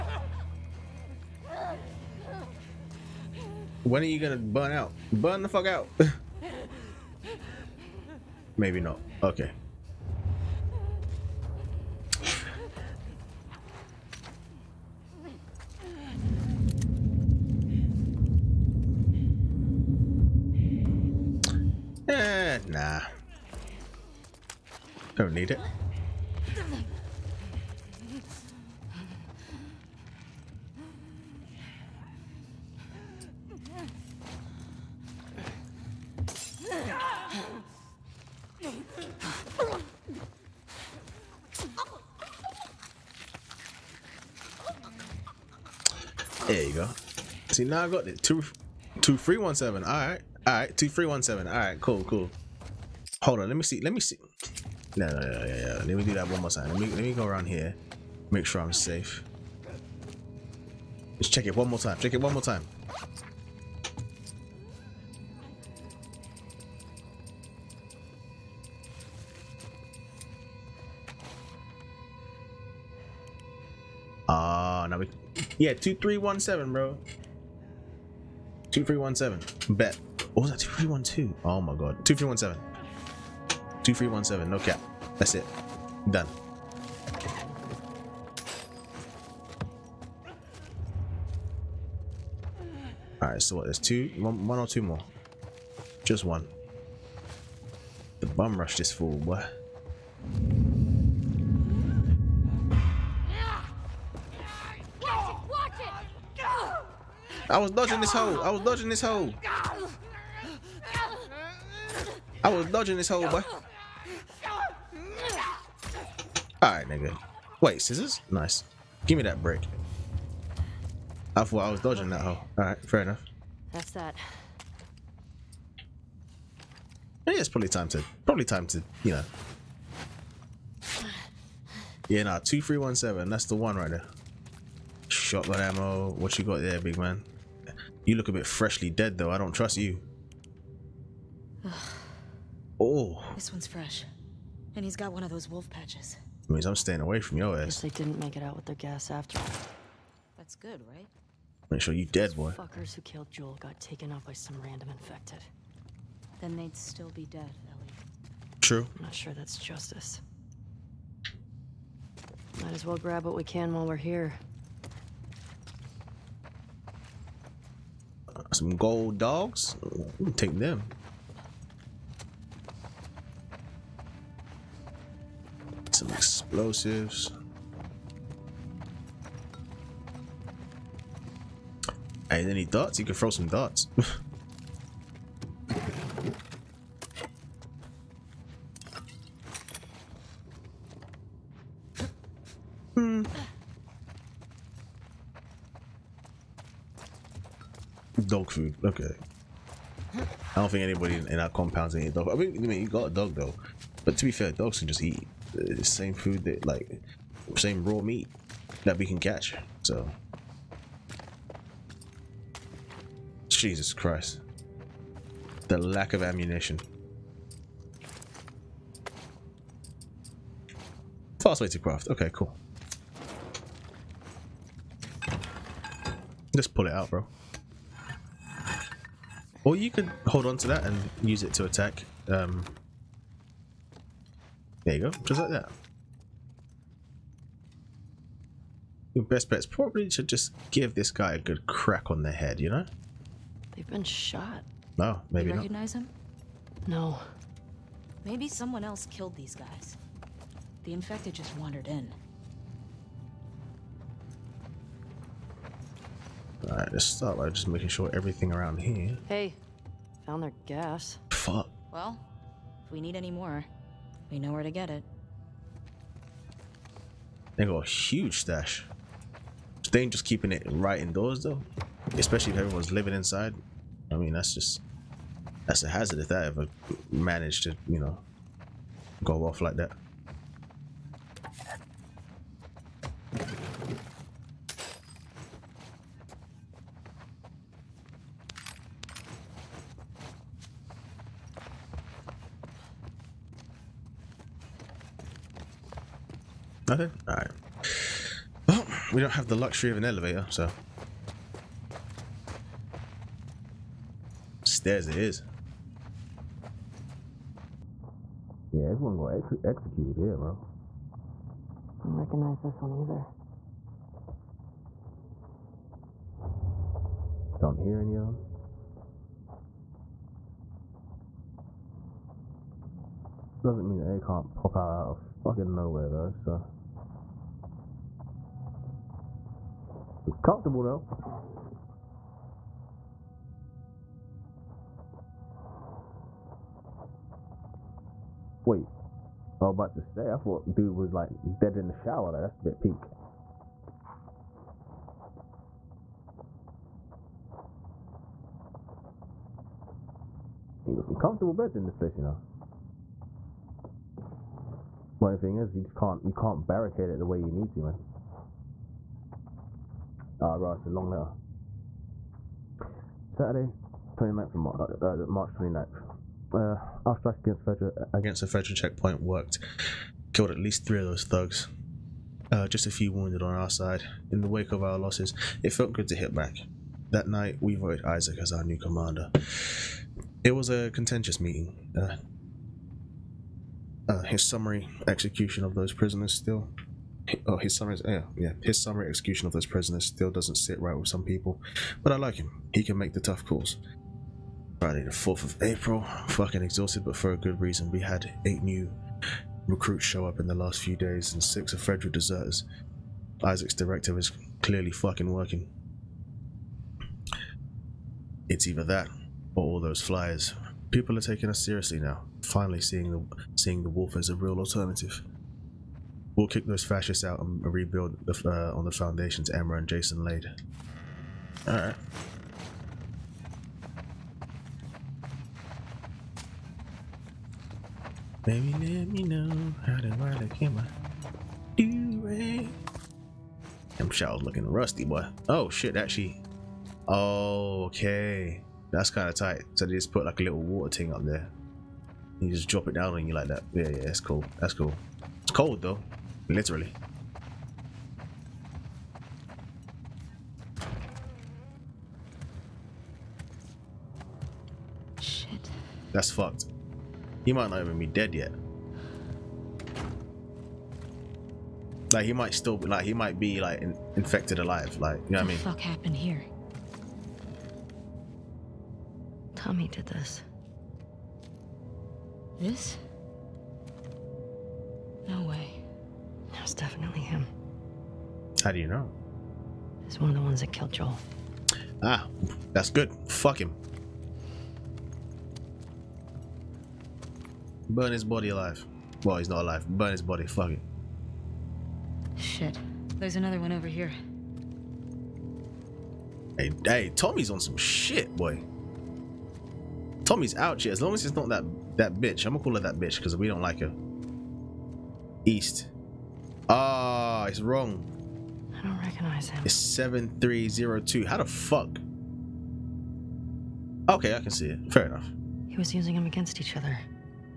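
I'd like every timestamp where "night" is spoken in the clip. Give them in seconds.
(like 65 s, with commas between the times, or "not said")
377 s.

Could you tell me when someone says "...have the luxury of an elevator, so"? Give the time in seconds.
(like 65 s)
299 s.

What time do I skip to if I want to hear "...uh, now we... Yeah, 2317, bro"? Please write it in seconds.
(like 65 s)
74 s.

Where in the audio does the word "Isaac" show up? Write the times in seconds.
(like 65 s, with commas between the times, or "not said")
378 s, 403 s.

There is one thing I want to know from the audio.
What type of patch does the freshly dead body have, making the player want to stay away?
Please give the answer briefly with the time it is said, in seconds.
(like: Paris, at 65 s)
wolf patches, at 145 s.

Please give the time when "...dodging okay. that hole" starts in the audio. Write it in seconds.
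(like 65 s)
121 s.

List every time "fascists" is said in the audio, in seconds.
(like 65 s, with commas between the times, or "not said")
416 s.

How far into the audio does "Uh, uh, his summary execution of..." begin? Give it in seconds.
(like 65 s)
381 s.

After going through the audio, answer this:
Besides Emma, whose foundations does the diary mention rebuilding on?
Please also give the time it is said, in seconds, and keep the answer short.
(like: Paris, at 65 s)
Jason, at 419 s.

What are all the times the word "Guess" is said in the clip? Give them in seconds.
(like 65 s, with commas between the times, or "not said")
147 s.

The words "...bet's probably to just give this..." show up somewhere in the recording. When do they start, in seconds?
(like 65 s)
239 s.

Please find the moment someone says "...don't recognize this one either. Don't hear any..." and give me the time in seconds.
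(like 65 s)
312 s.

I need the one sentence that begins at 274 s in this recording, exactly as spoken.
I mean, that's just, that's a hazard if that ever managed to, you know, go off like that.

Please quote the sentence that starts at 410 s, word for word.
People are taking us seriously now.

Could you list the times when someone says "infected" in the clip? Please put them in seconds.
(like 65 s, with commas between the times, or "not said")
154 s, 250 s, 464 s.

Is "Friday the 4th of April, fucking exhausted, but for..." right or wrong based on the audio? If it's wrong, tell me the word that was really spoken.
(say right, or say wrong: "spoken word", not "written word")
right.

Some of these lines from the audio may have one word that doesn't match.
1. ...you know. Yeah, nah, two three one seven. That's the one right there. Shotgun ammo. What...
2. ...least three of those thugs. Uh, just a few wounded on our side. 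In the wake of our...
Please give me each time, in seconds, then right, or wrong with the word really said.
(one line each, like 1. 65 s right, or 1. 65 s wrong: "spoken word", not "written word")
1. 129 s right
2. 370 s right.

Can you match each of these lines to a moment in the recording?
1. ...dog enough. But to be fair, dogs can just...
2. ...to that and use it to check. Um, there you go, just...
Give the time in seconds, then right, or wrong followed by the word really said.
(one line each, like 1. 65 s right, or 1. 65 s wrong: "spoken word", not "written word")
1. 203 s wrong: "though", not "enough"
2. 230 s wrong: "attack", not "check".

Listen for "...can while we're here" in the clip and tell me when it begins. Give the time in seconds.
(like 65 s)
163 s.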